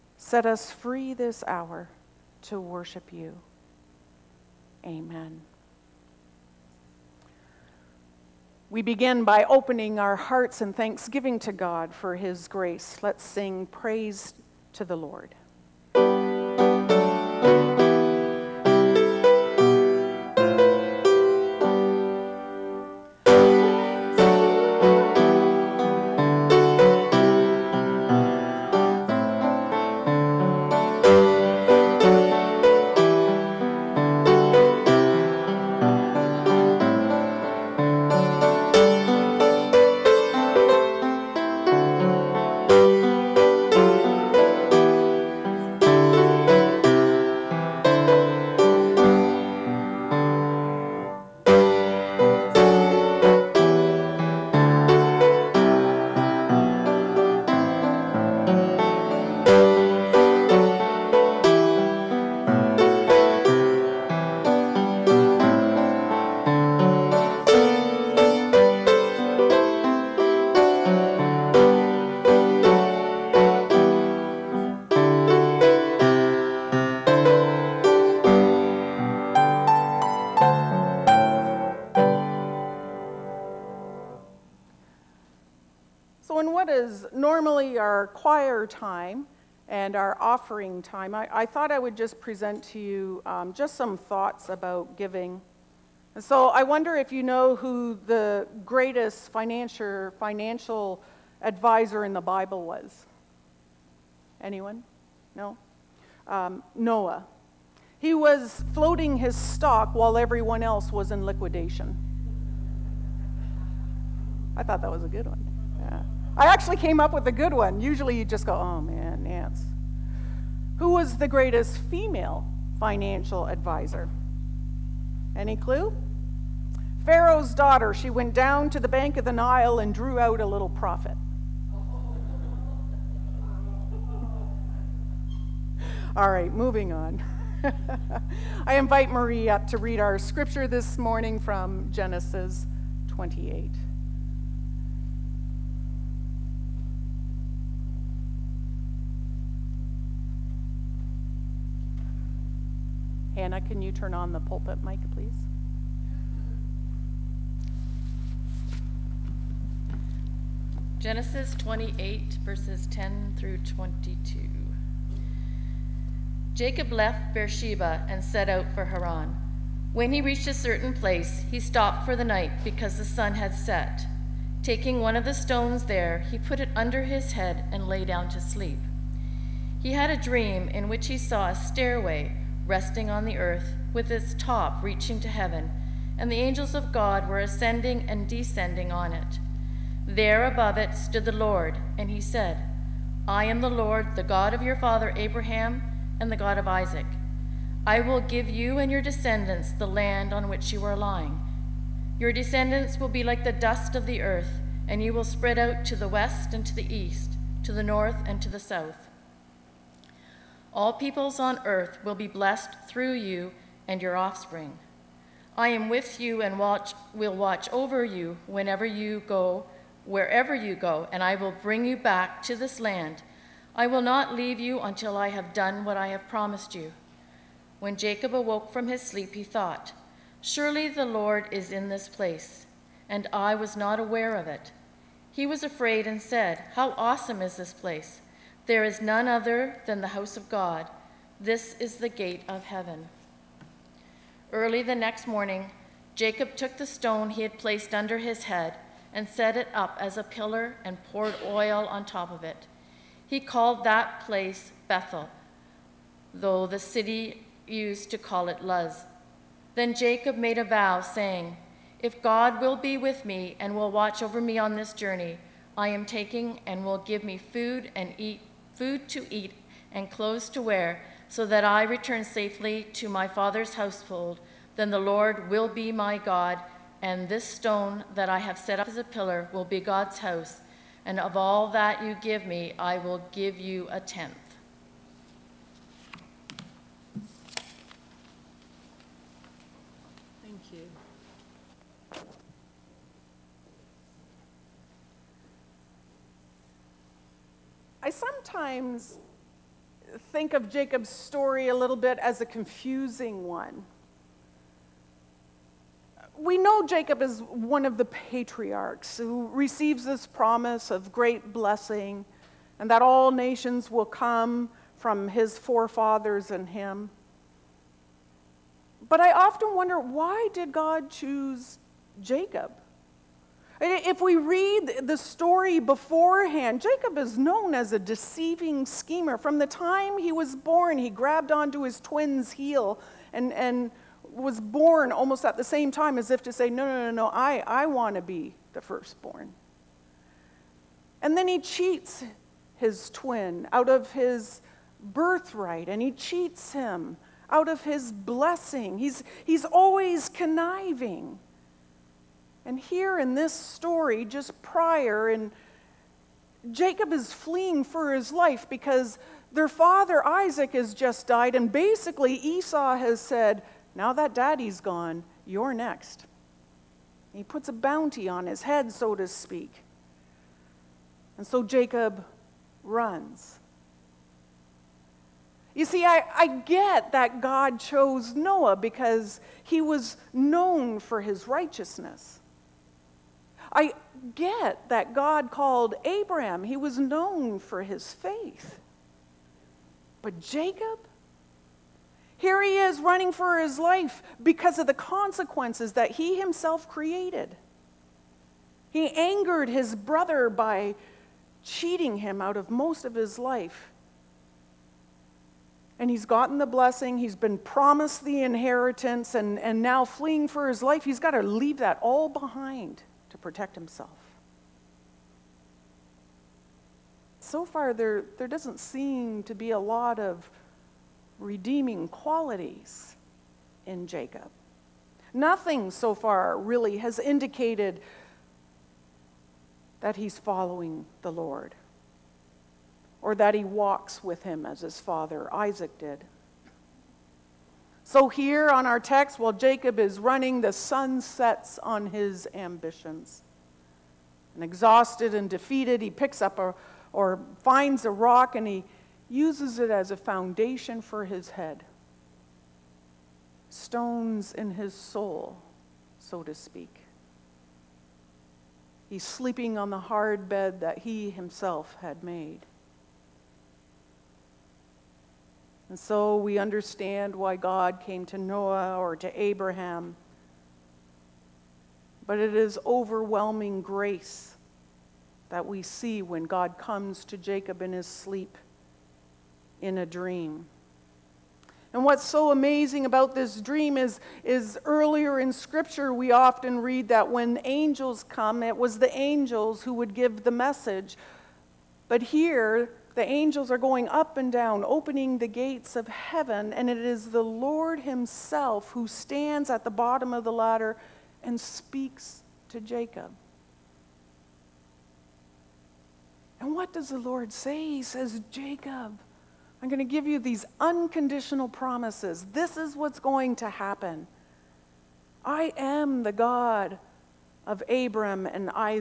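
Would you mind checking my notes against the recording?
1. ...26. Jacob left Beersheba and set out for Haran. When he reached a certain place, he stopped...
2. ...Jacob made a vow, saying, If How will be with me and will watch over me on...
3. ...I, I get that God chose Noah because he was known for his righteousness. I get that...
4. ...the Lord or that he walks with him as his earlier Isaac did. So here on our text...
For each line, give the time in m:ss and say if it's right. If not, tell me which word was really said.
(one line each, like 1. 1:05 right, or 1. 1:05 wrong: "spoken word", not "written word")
1. 2:43 wrong: "22", not "26"
2. 4:19 wrong: "God", not "How"
3. 6:16 right
4. 7:11 wrong: "father", not "earlier".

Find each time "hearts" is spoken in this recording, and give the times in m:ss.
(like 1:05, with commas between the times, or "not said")
0:10.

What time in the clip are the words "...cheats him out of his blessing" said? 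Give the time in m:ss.
5:46.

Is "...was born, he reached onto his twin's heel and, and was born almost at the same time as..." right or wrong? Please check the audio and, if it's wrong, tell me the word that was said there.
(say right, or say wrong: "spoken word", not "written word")
wrong: "grabbed", not "reached".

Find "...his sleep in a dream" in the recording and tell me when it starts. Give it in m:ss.
7:57.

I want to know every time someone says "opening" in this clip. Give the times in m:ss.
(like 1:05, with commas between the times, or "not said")
0:09, 8:14.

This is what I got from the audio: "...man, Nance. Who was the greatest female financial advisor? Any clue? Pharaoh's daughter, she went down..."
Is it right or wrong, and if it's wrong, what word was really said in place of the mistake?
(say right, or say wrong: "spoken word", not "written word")
right.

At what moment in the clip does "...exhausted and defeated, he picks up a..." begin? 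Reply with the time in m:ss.
7:24.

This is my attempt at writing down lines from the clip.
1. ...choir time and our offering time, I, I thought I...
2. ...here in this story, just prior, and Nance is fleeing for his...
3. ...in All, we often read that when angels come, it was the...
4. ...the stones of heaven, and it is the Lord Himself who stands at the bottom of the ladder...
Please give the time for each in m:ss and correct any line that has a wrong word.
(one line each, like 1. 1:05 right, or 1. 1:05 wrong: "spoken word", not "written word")
1. 1:28 right
2. 5:52 wrong: "Jacob", not "Nance"
3. 8:05 wrong: "Scripture", not "All"
4. 8:15 wrong: "gates", not "stones".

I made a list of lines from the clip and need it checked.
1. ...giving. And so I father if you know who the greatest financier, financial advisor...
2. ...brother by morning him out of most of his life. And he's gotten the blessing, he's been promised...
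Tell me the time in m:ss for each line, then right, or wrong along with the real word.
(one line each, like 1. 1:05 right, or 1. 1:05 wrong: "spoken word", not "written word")
1. 1:34 wrong: "wonder", not "father"
2. 6:39 wrong: "cheating", not "morning".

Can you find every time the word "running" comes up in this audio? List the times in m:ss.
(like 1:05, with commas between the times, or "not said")
6:32, 7:20.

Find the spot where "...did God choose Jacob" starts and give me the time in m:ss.
5:20.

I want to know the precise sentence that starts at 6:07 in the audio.
He puts a bounty on his head, so to speak.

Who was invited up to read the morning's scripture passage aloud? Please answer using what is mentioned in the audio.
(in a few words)
Marie.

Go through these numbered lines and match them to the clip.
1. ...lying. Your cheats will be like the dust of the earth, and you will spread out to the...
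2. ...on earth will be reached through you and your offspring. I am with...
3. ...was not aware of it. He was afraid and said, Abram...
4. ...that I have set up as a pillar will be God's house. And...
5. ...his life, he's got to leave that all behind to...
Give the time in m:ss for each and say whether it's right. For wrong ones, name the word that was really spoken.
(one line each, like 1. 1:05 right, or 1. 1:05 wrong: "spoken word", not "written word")
1. 3:20 wrong: "descendants", not "cheats"
2. 3:31 wrong: "blessed", not "reached"
3. 3:53 wrong: "How", not "Abram"
4. 4:38 right
5. 6:50 right.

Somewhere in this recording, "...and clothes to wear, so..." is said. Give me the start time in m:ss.
4:29.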